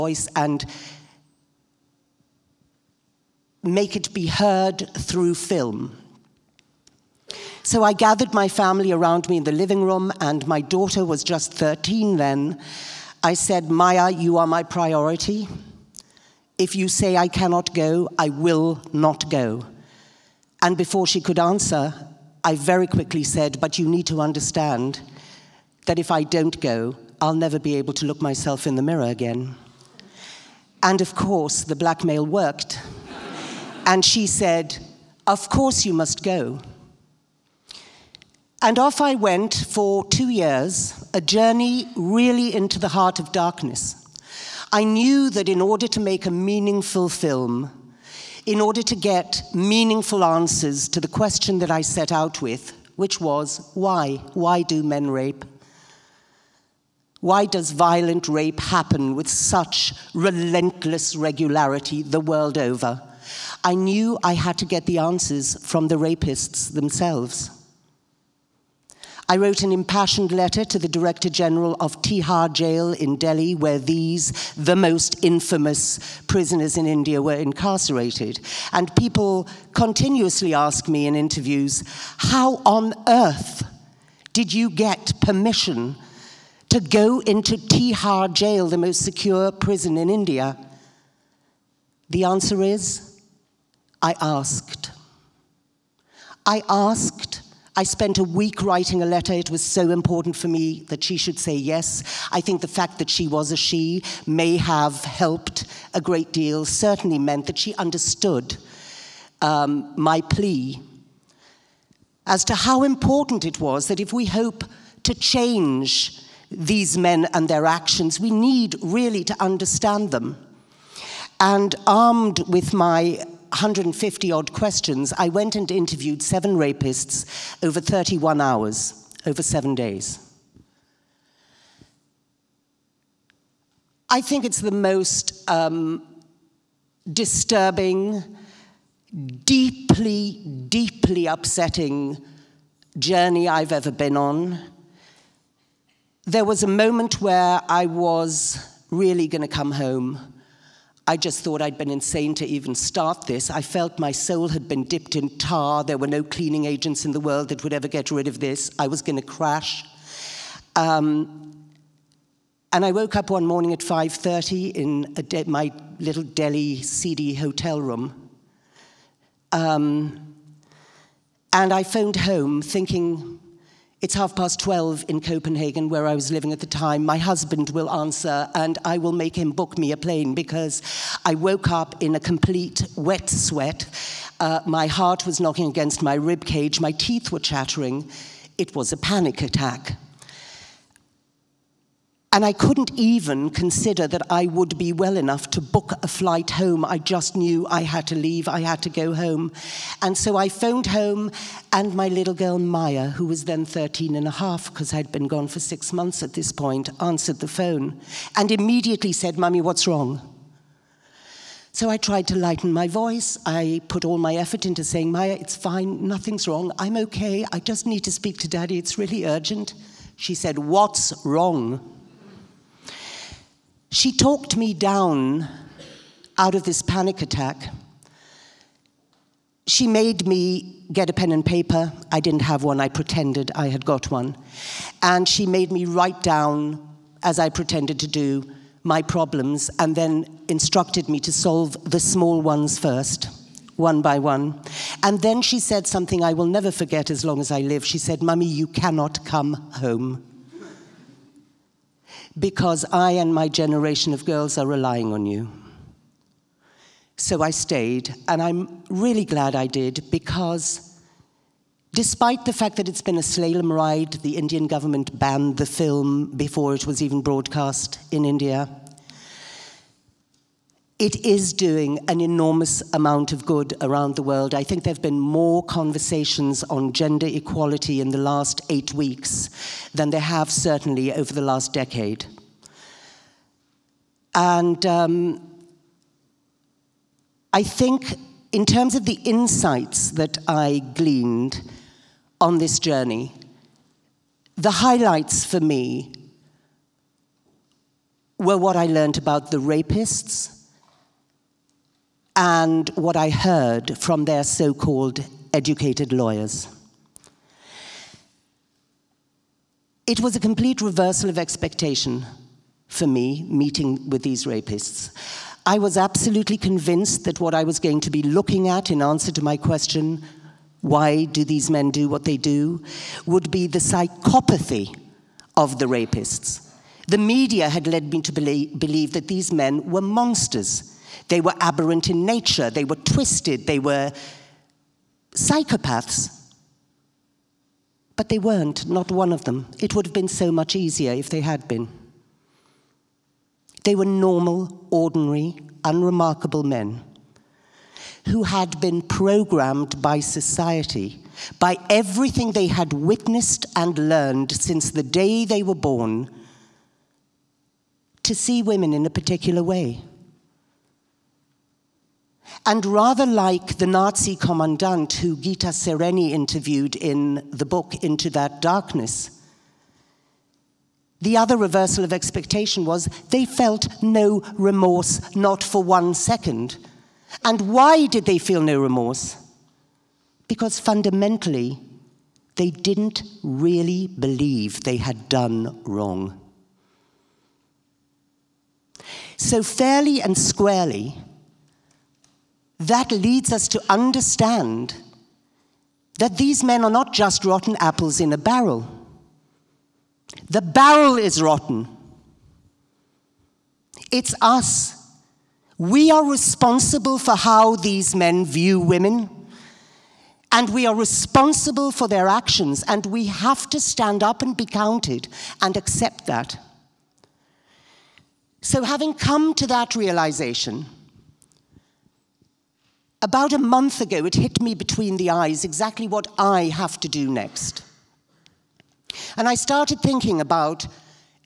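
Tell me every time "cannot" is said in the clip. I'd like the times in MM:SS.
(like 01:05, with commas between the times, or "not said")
00:17, 04:08.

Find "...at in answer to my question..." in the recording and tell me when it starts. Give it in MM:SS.
05:18.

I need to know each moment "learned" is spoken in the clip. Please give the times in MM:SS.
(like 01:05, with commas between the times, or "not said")
04:58, 05:54.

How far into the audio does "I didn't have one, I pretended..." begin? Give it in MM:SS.
03:52.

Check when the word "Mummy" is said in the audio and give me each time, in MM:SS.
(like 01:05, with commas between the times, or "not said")
03:29, 04:08.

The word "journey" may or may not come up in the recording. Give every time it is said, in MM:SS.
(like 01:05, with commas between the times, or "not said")
00:41, 02:22, 04:52.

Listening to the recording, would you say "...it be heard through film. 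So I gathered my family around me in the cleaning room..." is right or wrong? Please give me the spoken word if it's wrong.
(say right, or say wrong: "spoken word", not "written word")
wrong: "living", not "cleaning".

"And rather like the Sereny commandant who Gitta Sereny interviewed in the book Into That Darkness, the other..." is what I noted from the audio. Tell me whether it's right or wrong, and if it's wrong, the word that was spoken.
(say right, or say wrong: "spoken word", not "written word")
wrong: "Nazi", not "Sereny".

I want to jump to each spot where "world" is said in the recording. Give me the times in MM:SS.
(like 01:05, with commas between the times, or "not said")
01:02, 02:37, 04:34.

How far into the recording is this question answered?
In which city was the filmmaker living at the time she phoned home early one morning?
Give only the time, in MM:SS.
02:55.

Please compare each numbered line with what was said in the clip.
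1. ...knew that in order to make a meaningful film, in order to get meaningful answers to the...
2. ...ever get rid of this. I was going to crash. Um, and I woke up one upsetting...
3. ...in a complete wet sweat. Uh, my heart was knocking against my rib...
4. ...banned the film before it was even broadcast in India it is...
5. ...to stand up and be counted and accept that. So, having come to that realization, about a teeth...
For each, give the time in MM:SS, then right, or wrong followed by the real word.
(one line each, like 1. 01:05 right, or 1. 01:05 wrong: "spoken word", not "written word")
1. 00:44 right
2. 02:37 wrong: "morning", not "upsetting"
3. 03:02 right
4. 04:25 right
5. 06:53 wrong: "month", not "teeth".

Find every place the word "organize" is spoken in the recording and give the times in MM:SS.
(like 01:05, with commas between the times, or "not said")
not said.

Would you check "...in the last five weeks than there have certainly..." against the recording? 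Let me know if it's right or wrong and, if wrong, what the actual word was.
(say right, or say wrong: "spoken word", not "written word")
wrong: "eight", not "five".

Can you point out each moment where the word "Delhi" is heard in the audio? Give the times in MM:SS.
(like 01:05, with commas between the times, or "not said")
01:13, 02:46.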